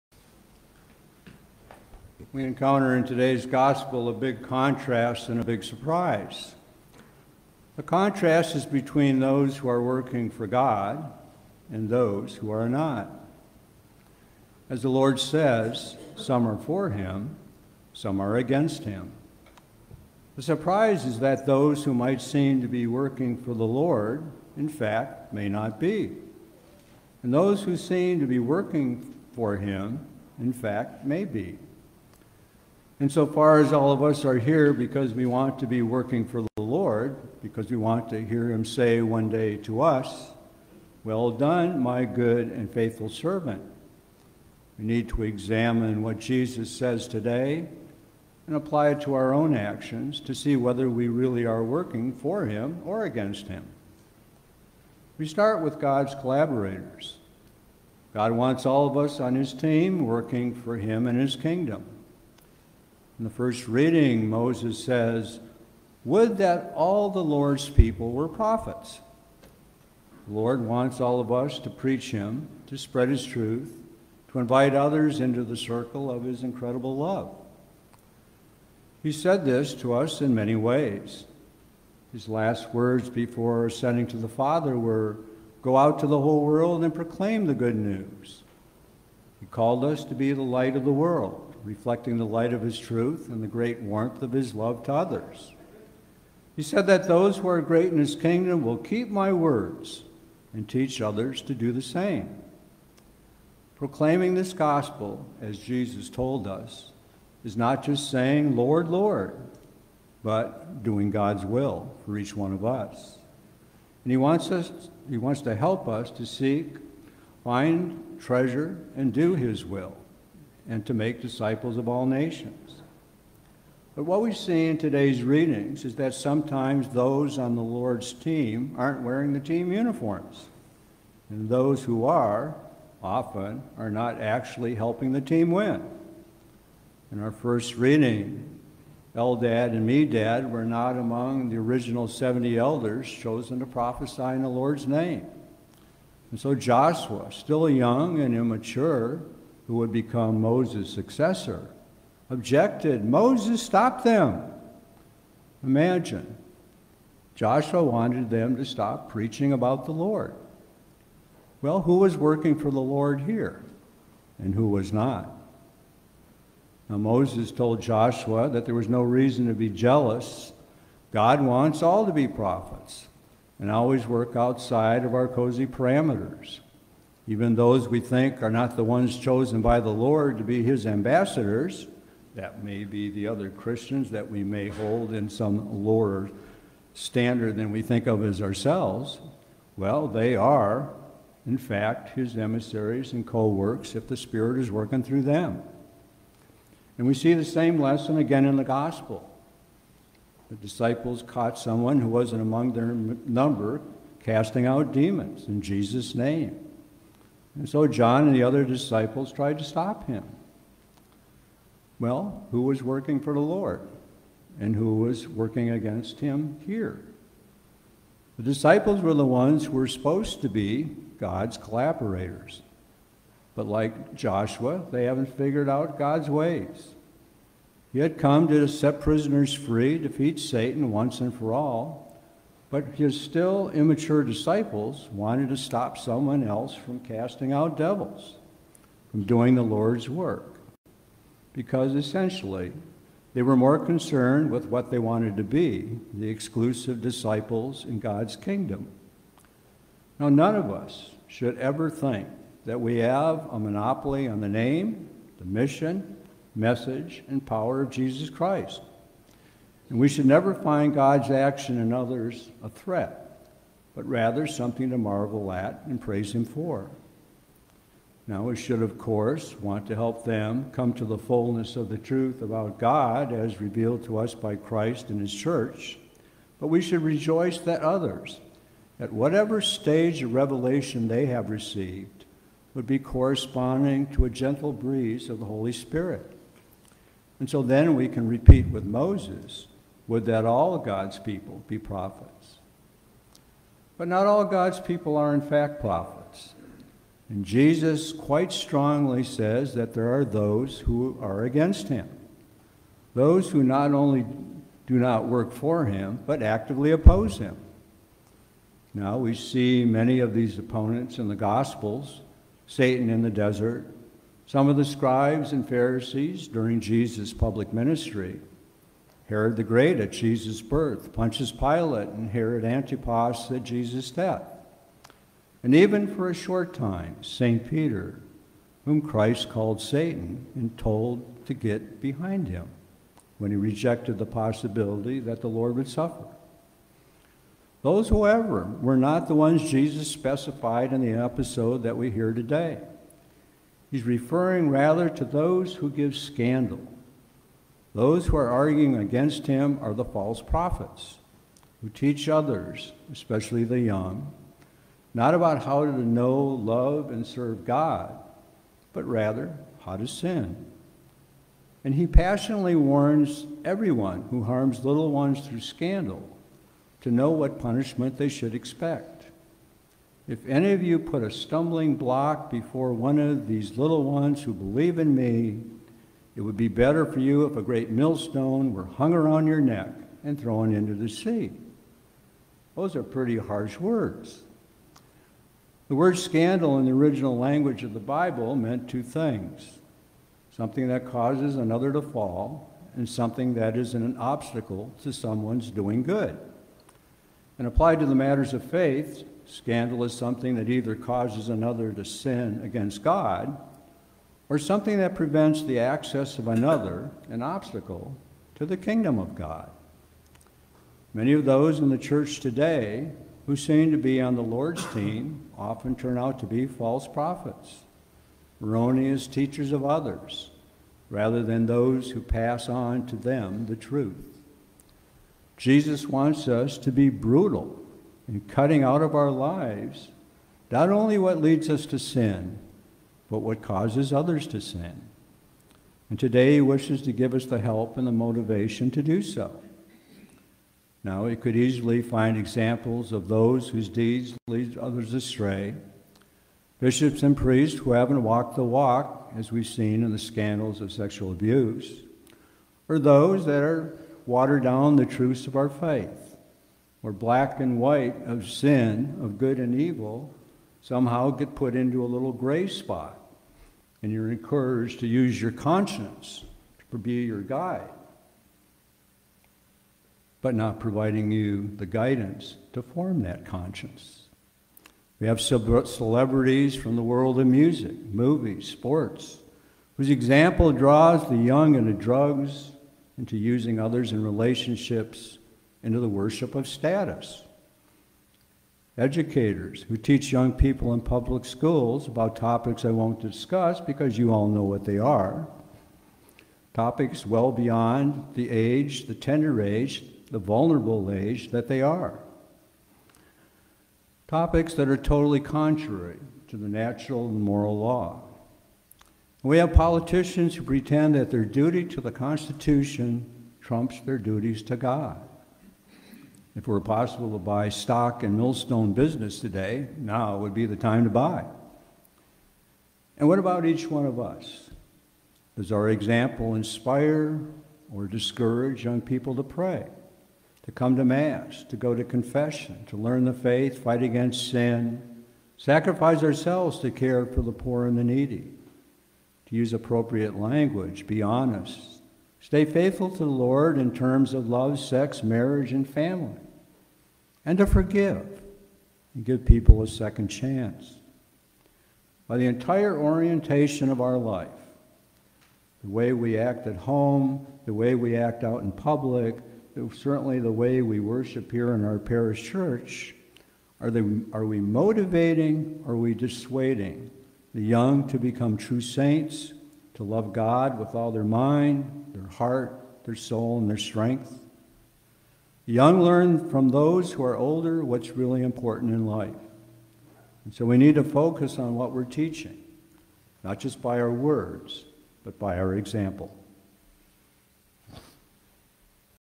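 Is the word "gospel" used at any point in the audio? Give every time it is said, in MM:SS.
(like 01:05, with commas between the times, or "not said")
00:03, 01:44, 03:18, 05:11.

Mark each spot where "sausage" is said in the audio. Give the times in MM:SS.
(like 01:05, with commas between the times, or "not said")
not said.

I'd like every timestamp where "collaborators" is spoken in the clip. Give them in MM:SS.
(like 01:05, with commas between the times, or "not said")
00:56, 03:41.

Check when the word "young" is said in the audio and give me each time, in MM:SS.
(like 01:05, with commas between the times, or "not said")
02:27, 05:53, 08:01, 08:10, 08:48, 09:27, 09:35.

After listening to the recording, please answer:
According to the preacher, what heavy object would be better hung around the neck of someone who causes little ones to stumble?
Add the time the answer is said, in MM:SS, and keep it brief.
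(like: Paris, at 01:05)
a great millstone, at 06:17.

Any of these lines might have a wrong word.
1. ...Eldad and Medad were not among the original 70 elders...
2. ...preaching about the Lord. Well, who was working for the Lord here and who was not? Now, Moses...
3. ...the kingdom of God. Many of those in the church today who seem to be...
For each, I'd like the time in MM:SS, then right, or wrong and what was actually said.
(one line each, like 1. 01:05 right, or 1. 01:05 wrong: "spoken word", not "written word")
1. 02:19 right
2. 02:39 right
3. 06:48 right.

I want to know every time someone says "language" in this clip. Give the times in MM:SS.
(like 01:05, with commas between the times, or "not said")
06:27, 09:00.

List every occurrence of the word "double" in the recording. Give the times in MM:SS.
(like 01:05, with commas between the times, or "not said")
not said.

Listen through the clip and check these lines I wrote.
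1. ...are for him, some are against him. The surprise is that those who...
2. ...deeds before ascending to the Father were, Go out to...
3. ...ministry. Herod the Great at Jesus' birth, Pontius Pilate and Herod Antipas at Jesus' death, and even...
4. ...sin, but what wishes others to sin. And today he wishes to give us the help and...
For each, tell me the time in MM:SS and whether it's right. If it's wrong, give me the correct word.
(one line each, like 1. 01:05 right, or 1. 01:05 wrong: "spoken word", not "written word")
1. 00:16 right
2. 01:22 wrong: "words", not "deeds"
3. 05:17 right
4. 07:11 wrong: "causes", not "wishes".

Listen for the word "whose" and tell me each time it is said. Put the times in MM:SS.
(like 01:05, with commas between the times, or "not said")
07:23, 07:59.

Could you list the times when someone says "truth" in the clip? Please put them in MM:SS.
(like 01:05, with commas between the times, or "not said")
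01:13, 01:32, 04:31, 07:03, 07:35.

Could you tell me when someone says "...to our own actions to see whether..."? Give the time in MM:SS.
00:49.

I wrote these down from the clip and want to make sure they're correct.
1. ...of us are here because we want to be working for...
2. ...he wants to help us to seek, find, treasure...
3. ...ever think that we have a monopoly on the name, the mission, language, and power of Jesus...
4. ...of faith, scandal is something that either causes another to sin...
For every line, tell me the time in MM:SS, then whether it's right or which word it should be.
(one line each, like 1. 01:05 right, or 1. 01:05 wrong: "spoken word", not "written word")
1. 00:33 right
2. 01:55 right
3. 04:11 wrong: "message", not "language"
4. 06:38 right.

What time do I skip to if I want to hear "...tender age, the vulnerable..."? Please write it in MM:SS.
08:19.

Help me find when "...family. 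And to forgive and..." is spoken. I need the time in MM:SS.
09:05.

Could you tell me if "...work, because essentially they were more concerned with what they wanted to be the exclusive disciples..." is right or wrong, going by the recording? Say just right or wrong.
right.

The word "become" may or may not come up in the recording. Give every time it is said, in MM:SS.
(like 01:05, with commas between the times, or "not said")
02:29, 09:28.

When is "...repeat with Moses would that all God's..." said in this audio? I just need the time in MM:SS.
04:48.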